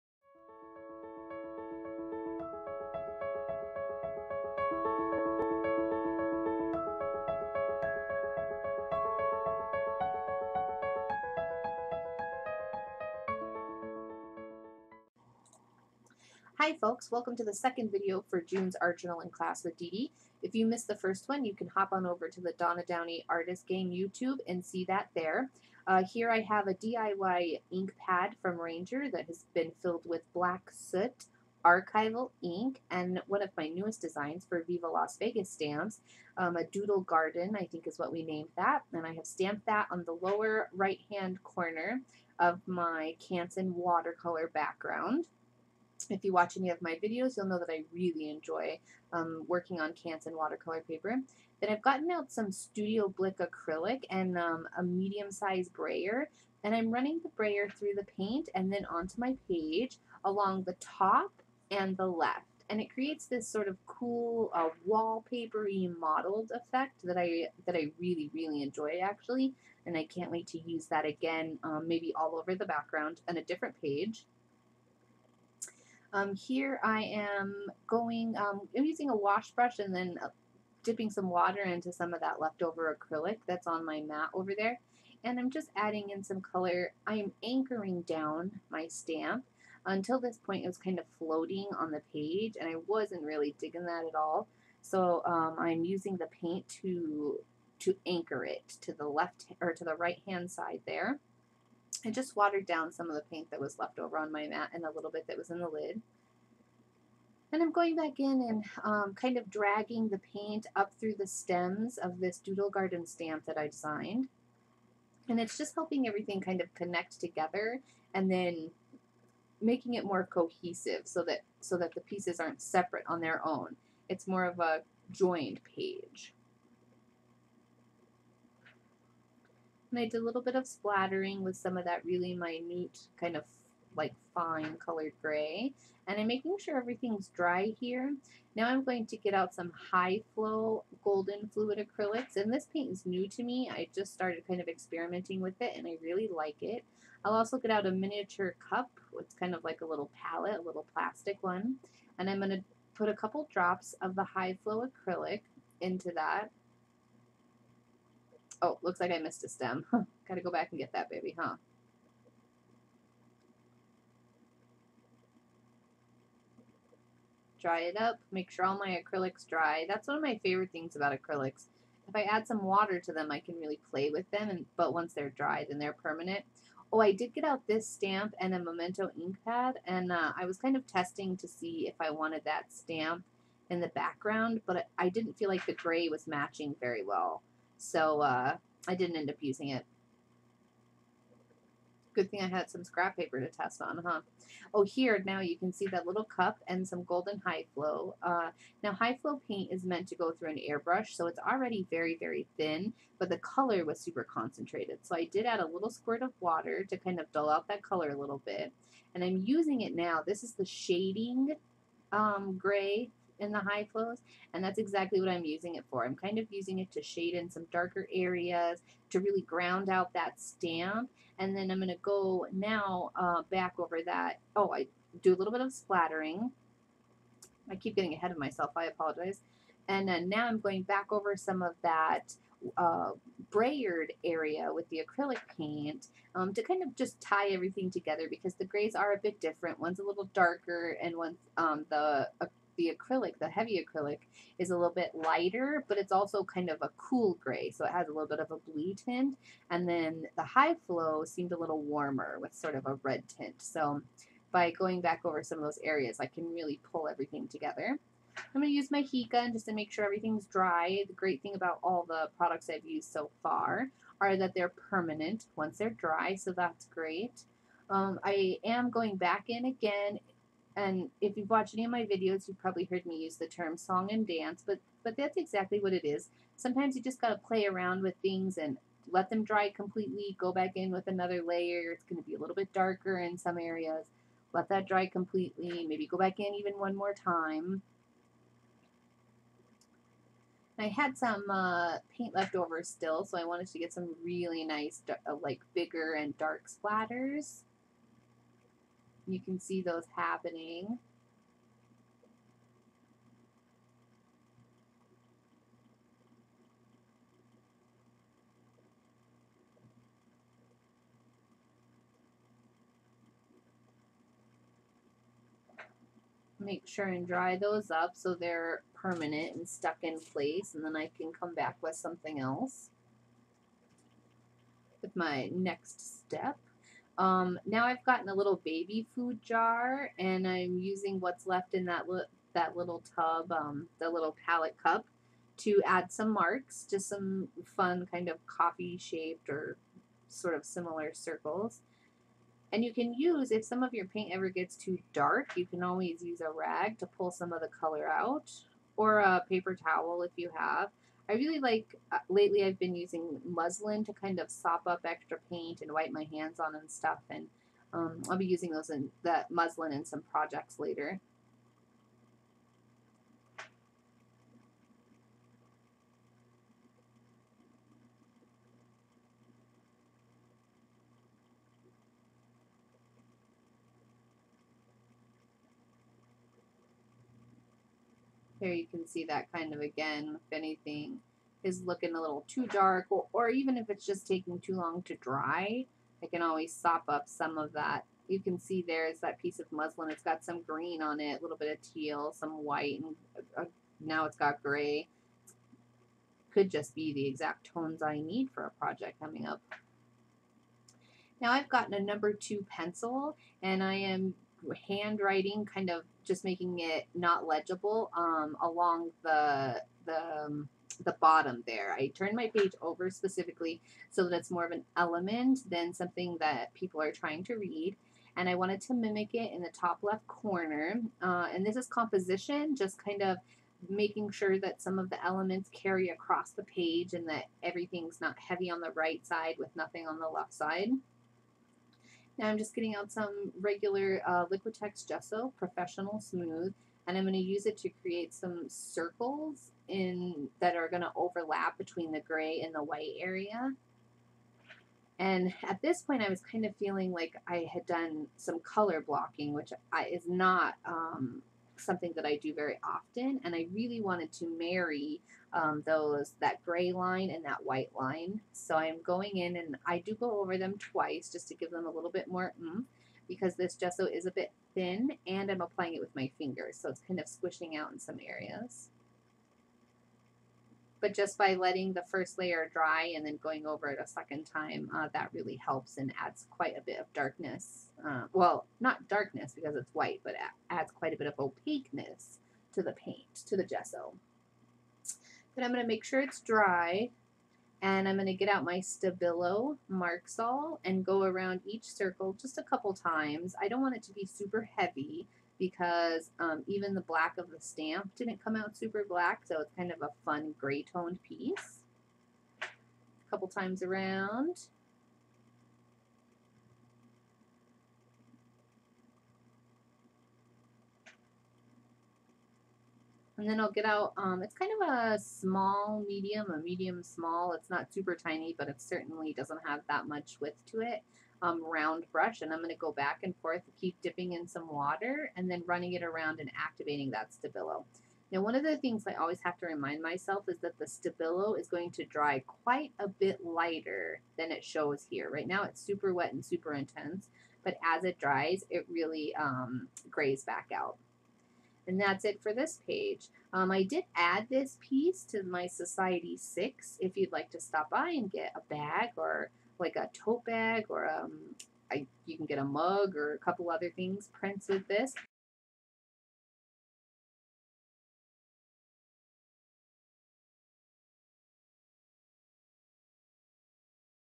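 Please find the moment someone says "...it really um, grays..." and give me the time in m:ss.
8:58.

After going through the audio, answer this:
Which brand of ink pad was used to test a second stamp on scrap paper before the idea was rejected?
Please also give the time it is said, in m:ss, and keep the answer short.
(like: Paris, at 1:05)
Memento, at 2:58.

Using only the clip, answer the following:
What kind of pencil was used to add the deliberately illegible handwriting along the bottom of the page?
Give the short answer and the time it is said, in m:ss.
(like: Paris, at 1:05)
number 2 pencil, at 6:41.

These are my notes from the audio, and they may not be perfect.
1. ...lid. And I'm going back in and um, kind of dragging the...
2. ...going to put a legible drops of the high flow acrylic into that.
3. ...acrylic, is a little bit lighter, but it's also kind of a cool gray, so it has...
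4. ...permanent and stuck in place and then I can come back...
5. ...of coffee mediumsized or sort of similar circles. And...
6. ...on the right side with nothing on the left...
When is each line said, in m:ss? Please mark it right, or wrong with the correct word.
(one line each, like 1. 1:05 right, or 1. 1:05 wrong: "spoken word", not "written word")
1. 1:45 right
2. 2:32 wrong: "couple", not "legible"
3. 4:03 right
4. 5:18 right
5. 5:38 wrong: "shaped", not "mediumsized"
6. 7:08 right.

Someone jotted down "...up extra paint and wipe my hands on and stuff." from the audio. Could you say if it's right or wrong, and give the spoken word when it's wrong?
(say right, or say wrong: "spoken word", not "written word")
right.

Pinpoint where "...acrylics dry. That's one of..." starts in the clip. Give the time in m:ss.
2:49.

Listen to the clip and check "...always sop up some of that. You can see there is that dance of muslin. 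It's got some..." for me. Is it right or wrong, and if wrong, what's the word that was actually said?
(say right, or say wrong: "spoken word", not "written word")
wrong: "piece", not "dance".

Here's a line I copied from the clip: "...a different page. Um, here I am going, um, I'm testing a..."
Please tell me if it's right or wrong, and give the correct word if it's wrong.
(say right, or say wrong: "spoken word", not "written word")
wrong: "using", not "testing".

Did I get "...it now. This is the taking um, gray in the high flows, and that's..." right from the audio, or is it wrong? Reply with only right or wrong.
wrong.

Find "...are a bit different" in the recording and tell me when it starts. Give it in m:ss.
3:58.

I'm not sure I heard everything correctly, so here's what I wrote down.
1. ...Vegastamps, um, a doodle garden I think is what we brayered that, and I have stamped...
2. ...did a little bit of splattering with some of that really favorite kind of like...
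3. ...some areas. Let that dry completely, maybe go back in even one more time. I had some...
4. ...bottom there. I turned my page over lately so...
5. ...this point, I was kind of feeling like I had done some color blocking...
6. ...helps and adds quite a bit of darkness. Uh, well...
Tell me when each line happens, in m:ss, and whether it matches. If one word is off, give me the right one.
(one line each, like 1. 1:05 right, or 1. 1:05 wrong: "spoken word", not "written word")
1. 0:35 wrong: "named", not "brayered"
2. 2:10 wrong: "minute", not "favorite"
3. 4:43 right
4. 6:51 wrong: "specifically", not "lately"
5. 7:25 right
6. 7:55 right.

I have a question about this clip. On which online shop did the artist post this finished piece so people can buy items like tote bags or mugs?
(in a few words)
Society 6.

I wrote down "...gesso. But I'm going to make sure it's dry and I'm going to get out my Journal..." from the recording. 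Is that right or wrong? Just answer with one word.
wrong.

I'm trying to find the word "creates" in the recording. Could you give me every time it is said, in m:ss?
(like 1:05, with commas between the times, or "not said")
1:02, 7:18.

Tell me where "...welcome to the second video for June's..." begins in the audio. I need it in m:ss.
0:17.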